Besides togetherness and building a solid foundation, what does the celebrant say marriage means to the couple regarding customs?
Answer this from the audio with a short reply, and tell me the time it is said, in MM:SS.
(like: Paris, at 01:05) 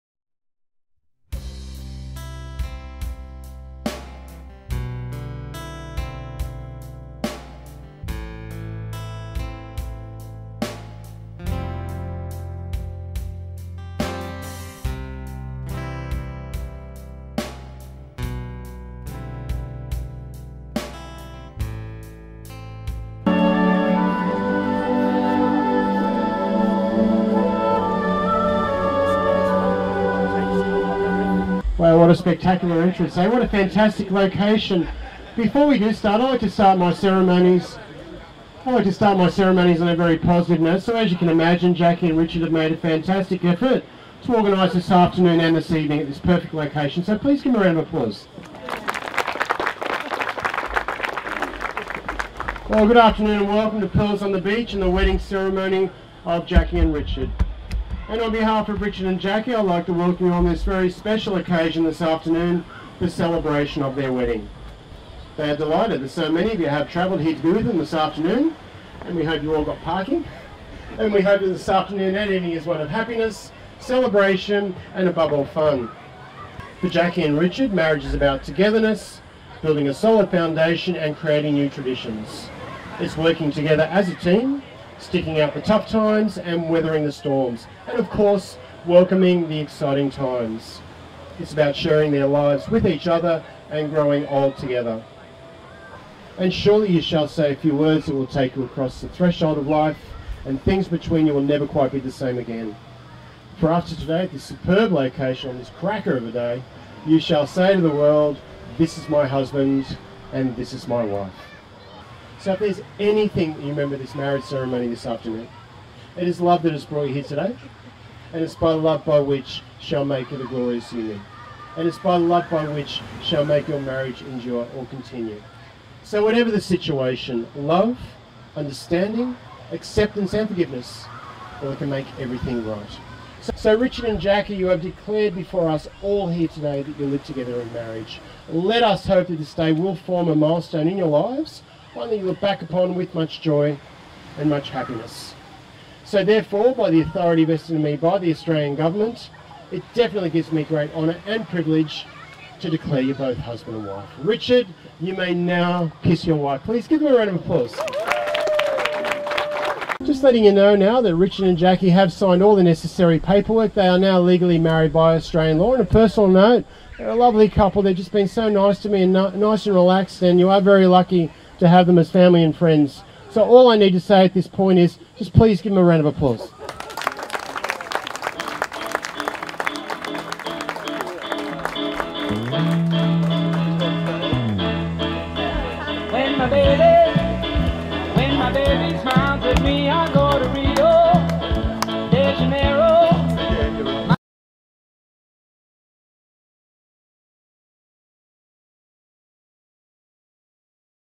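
creating new traditions, at 01:21.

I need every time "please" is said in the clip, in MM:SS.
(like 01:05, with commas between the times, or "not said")
00:47, 02:36, 02:55.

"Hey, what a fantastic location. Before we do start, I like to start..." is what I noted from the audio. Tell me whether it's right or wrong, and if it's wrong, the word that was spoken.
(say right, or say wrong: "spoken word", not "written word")
right.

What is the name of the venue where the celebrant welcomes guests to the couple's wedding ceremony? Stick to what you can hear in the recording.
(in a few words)
Pearls on the Beach.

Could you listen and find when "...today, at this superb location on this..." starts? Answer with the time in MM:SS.
01:43.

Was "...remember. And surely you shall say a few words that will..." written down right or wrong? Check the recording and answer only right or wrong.
wrong.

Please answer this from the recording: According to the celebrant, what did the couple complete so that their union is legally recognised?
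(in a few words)
necessary paperwork.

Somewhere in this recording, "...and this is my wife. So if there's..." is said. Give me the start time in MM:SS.
01:50.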